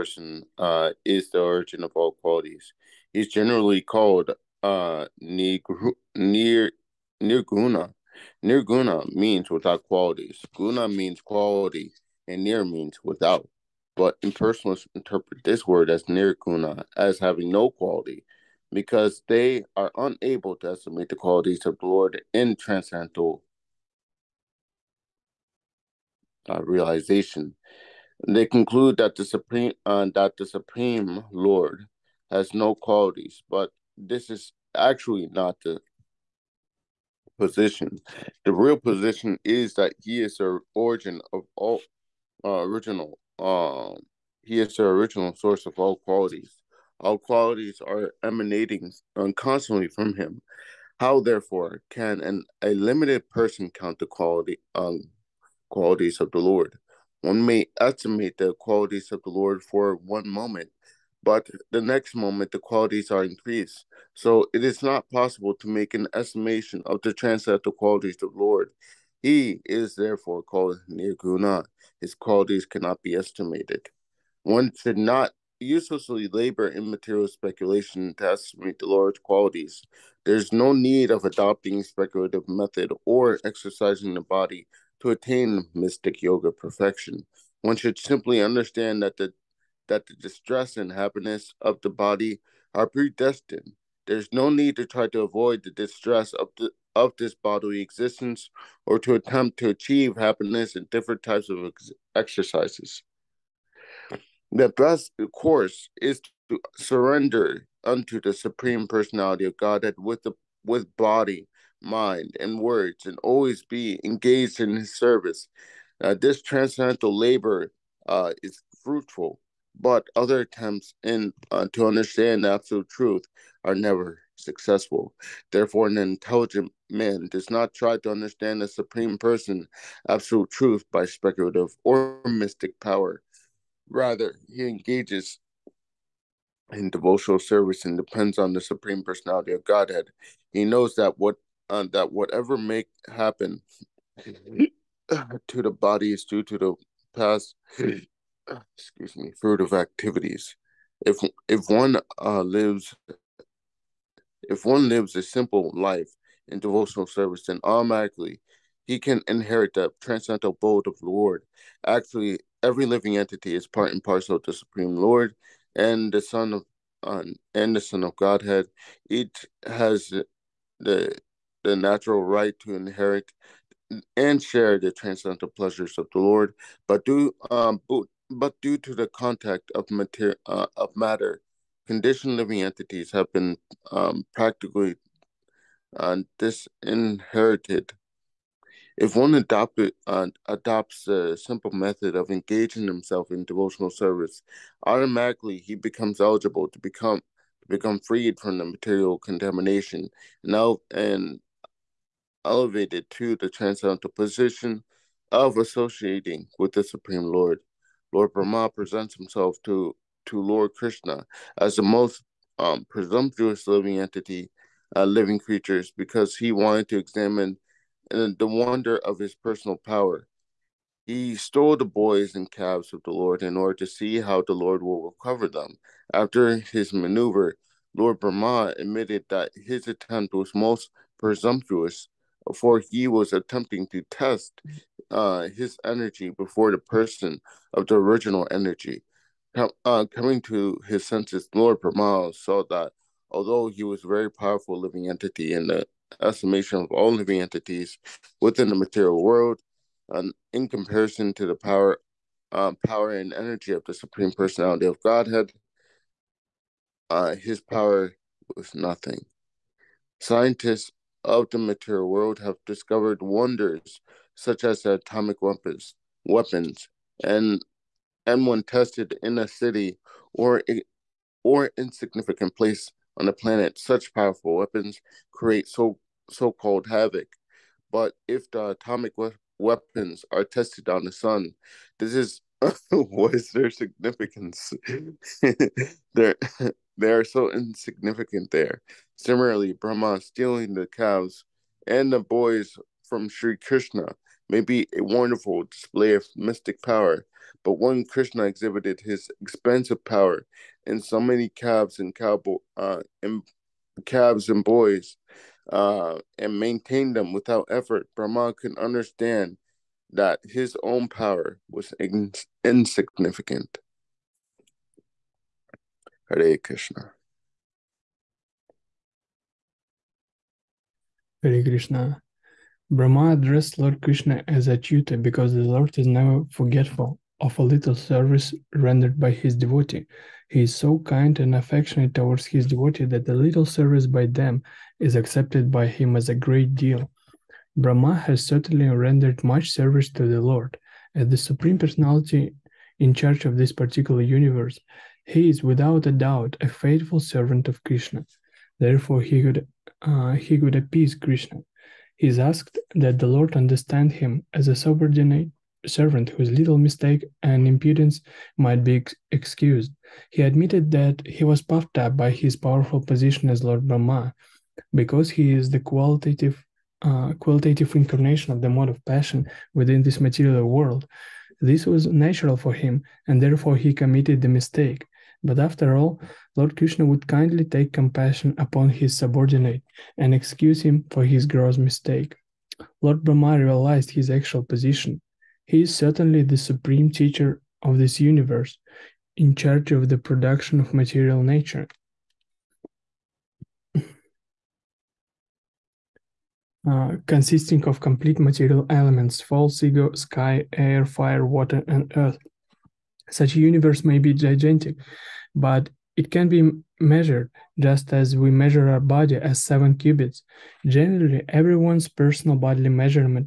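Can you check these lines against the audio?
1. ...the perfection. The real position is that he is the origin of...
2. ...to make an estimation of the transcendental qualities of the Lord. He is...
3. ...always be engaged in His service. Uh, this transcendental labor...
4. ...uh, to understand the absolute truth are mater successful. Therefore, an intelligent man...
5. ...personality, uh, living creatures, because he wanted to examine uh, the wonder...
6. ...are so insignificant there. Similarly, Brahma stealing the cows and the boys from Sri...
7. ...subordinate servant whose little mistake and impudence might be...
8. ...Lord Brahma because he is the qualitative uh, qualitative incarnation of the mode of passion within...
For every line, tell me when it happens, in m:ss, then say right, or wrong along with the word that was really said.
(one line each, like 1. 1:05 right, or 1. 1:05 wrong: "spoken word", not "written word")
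1. 0:35 wrong: "position", not "perfection"
2. 1:05 right
3. 1:53 right
4. 2:01 wrong: "never", not "mater"
5. 3:33 wrong: "entity", not "personality"
6. 4:47 right
7. 5:54 right
8. 6:03 right.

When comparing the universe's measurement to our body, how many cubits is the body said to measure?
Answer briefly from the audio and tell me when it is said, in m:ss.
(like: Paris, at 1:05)
7, at 6:49.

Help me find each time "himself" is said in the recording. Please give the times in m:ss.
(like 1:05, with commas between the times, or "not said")
3:12, 3:29.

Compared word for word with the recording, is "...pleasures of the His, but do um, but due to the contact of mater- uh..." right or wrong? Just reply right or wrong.
wrong.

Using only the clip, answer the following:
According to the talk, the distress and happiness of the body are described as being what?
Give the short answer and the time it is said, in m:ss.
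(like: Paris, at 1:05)
Predestined, at 1:32.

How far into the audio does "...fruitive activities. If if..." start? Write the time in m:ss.
2:29.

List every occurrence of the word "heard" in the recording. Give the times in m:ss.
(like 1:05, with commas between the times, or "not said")
not said.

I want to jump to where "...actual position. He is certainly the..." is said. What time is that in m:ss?
6:24.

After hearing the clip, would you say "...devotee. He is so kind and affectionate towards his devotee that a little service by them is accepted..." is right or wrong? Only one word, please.
right.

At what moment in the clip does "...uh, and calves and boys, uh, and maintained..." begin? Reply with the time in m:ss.
5:02.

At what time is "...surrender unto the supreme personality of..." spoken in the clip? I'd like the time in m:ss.
1:46.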